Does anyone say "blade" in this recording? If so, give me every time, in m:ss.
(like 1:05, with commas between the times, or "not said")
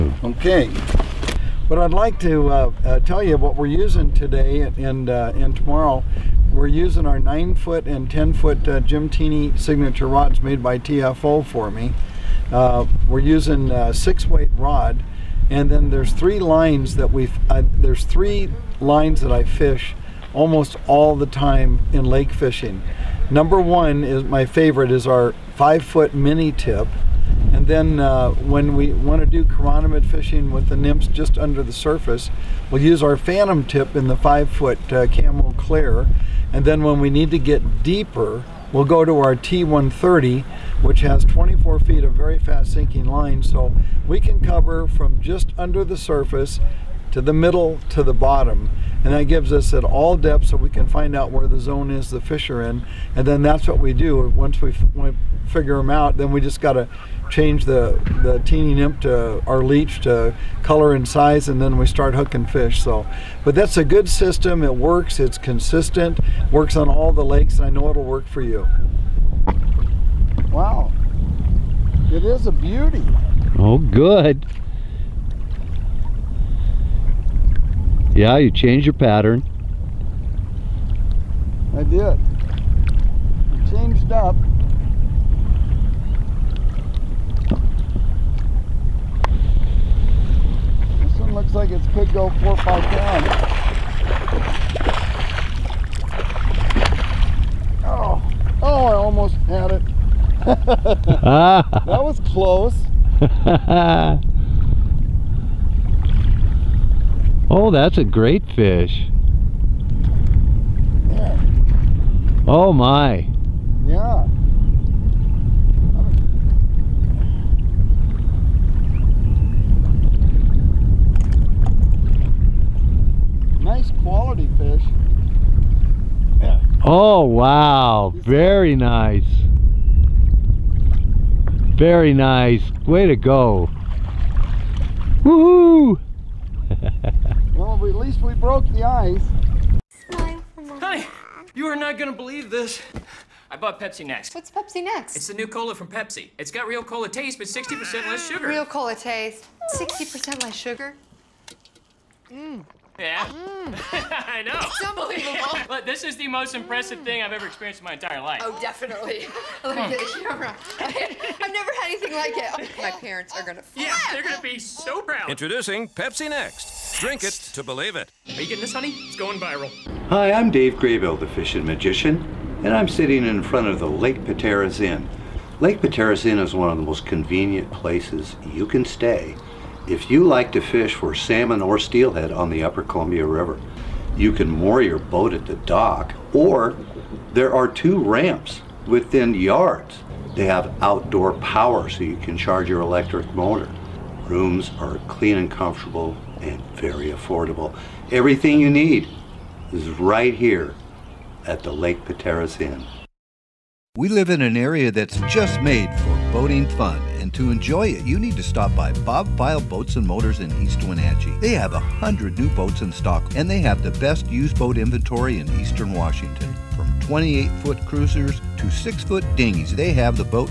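not said.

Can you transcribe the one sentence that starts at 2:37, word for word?
thing I've ever experienced in my entire life.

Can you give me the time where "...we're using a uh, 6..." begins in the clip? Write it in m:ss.
0:13.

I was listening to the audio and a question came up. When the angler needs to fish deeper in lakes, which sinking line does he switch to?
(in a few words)
T130.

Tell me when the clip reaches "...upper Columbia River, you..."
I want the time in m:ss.
3:02.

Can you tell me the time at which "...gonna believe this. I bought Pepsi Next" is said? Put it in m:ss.
2:21.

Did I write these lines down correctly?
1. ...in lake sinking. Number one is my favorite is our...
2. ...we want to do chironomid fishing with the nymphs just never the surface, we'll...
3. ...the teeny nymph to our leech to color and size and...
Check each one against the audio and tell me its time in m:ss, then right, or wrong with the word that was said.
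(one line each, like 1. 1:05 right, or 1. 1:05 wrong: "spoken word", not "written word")
1. 0:21 wrong: "fishing", not "sinking"
2. 0:28 wrong: "under", not "never"
3. 0:58 right.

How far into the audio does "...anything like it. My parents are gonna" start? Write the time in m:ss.
2:41.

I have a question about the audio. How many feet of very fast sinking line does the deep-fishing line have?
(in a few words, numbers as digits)
24.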